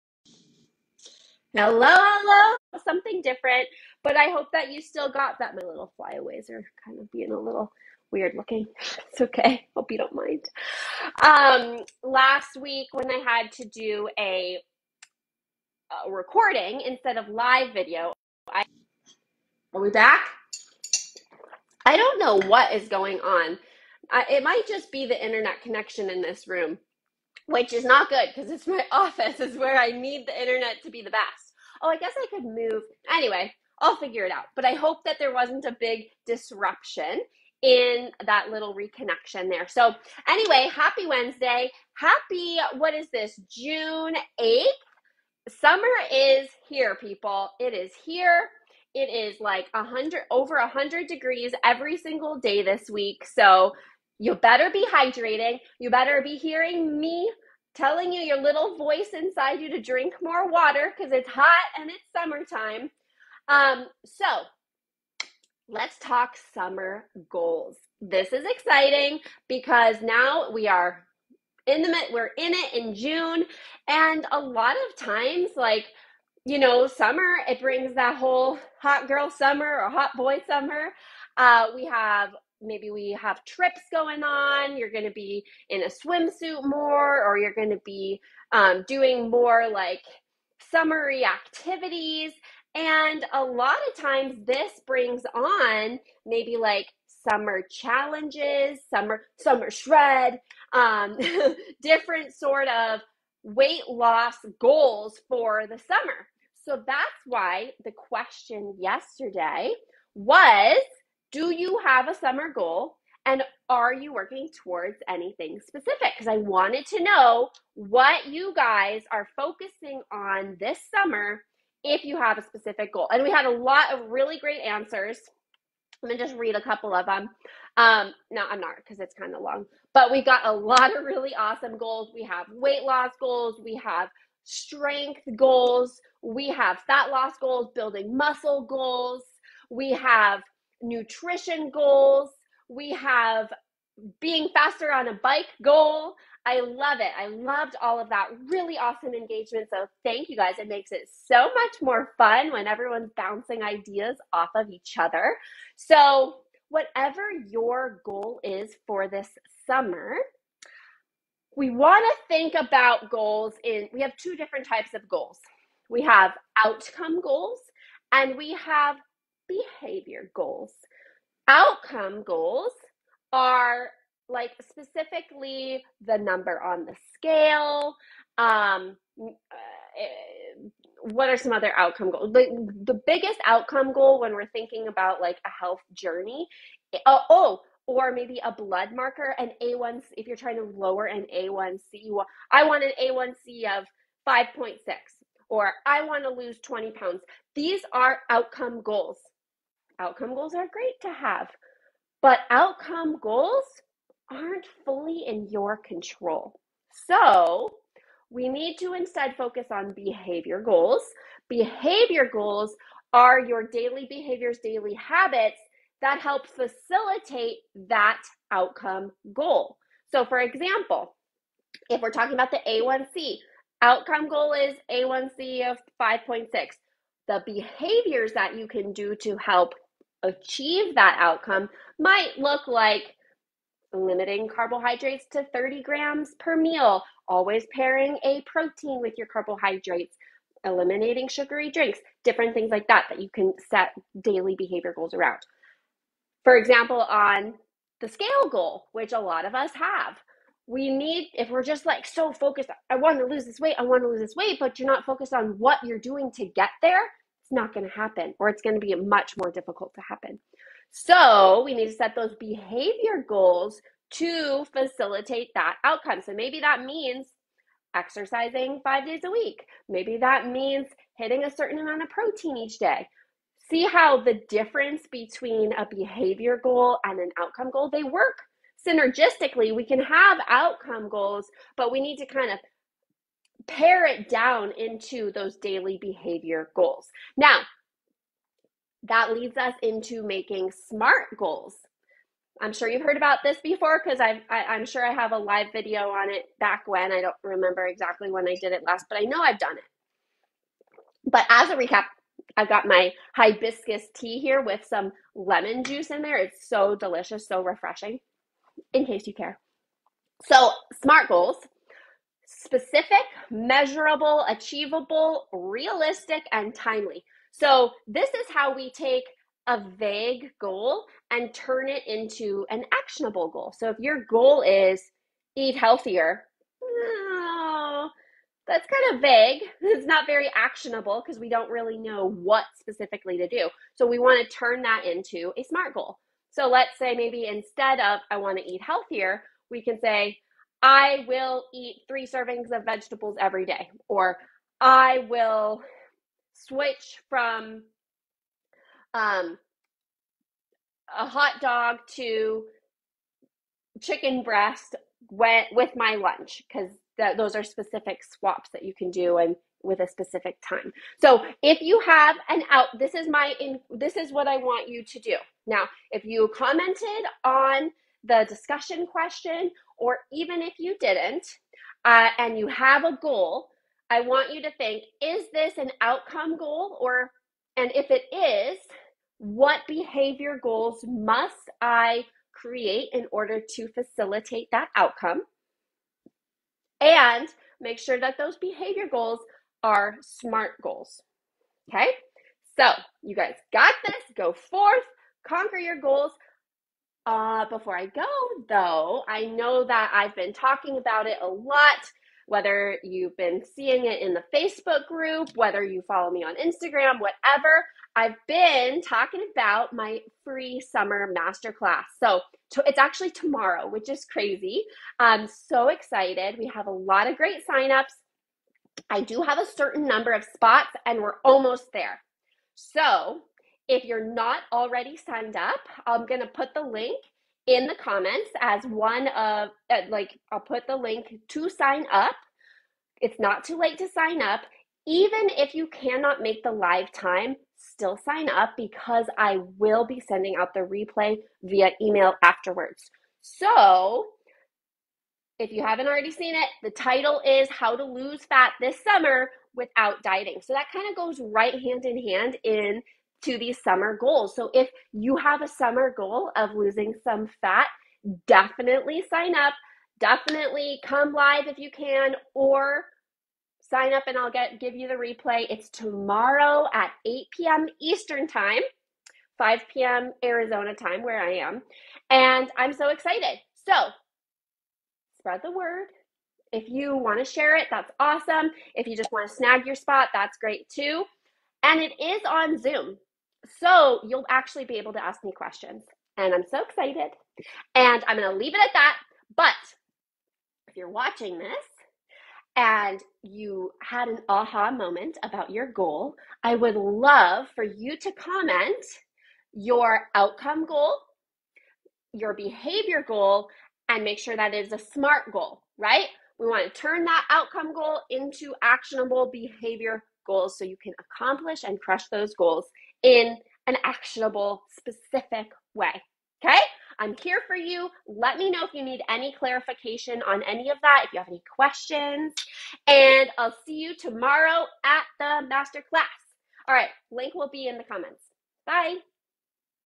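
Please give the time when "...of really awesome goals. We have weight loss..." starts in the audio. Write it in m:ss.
2:10.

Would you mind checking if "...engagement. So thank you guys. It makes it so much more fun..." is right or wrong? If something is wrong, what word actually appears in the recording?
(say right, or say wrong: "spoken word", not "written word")
right.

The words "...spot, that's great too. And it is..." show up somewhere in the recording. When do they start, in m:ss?
7:59.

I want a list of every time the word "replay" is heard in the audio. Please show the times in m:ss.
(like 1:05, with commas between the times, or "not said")
7:20, 7:45.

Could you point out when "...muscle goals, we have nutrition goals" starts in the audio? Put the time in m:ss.
2:18.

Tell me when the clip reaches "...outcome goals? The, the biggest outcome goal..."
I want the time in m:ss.
3:01.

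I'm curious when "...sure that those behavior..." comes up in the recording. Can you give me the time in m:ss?
6:27.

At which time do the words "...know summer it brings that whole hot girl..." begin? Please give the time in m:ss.
1:16.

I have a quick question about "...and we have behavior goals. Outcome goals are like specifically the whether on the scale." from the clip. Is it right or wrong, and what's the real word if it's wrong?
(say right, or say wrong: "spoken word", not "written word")
wrong: "number", not "whether".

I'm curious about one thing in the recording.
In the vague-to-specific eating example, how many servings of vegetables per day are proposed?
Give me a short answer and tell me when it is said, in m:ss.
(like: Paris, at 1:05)
3, at 5:42.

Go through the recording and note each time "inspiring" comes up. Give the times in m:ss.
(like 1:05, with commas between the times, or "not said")
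not said.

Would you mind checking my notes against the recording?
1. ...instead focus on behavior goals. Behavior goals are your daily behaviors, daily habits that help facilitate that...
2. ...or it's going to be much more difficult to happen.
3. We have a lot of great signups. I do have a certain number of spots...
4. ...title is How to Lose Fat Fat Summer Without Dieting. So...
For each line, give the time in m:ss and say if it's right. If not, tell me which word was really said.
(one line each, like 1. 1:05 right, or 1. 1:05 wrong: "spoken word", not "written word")
1. 3:28 right
2. 4:18 right
3. 6:56 right
4. 7:26 wrong: "This", not "Fat".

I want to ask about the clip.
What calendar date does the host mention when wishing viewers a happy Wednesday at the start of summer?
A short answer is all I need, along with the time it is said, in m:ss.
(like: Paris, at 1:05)
June 8th, at 0:43.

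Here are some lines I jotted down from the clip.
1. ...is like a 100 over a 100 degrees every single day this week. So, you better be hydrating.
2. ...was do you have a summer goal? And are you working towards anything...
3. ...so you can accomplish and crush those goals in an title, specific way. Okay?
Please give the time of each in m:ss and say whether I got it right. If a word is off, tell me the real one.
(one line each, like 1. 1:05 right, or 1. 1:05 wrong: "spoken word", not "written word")
1. 0:49 right
2. 1:50 right
3. 8:30 wrong: "actionable", not "title".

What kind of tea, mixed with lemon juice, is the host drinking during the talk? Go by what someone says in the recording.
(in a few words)
Hibiscus tea.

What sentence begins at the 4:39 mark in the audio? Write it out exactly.
We can have outcome goals, but we need to kind of pare it down into those daily behavior goals.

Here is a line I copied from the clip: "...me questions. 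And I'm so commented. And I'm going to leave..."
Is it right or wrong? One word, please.
wrong.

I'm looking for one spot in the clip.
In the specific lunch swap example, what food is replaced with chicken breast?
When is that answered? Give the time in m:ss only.
5:51.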